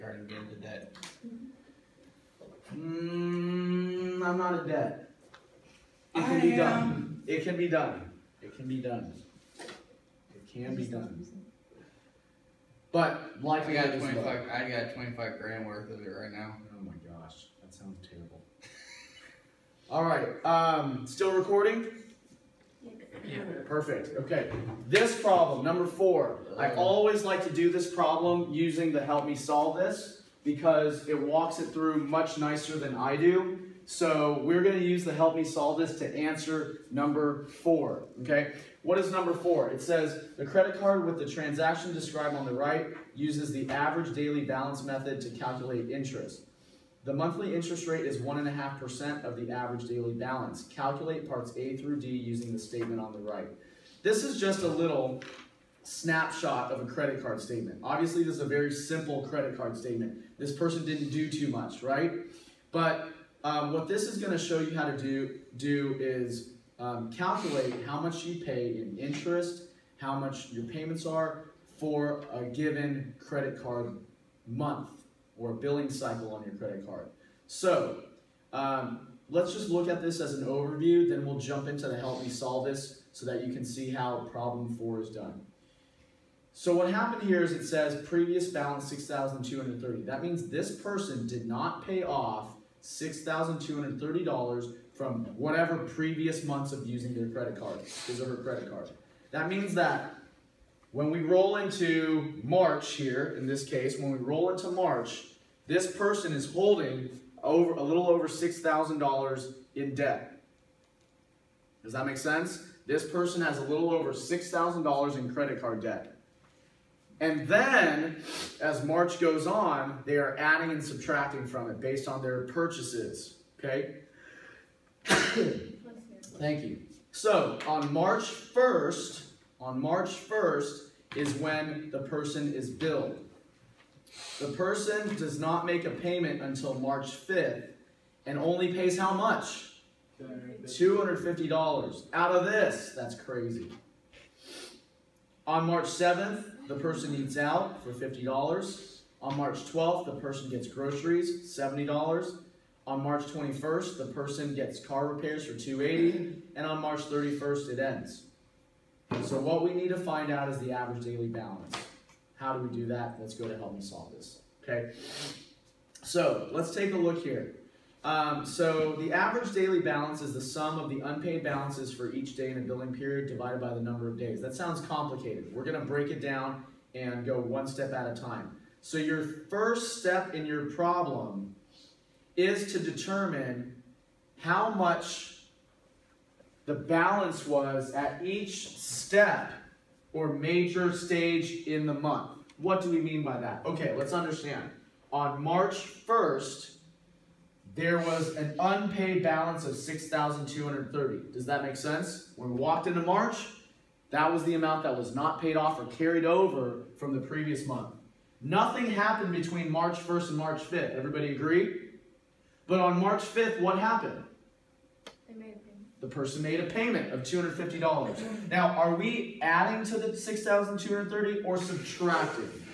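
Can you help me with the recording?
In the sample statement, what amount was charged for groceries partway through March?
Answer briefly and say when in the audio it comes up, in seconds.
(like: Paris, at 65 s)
$70, at 151 s.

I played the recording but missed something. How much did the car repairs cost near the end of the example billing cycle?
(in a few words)
280.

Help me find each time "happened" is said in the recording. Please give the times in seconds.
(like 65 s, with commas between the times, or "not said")
86 s, 208 s, 213 s.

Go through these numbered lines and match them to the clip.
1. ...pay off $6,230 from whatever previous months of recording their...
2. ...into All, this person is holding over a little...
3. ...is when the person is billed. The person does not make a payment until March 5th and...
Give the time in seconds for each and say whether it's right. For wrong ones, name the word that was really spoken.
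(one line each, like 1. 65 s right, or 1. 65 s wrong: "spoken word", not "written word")
1. 91 s wrong: "using", not "recording"
2. 104 s wrong: "March", not "All"
3. 131 s right.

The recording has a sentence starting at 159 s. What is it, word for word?
So what we need to find out is the average daily balance.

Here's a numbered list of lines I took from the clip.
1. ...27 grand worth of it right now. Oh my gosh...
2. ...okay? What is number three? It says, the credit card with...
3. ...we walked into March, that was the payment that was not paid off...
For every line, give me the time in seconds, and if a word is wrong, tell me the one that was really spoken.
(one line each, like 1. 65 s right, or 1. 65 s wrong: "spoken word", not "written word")
1. 14 s wrong: "25", not "27"
2. 38 s wrong: "four", not "three"
3. 202 s wrong: "amount", not "payment".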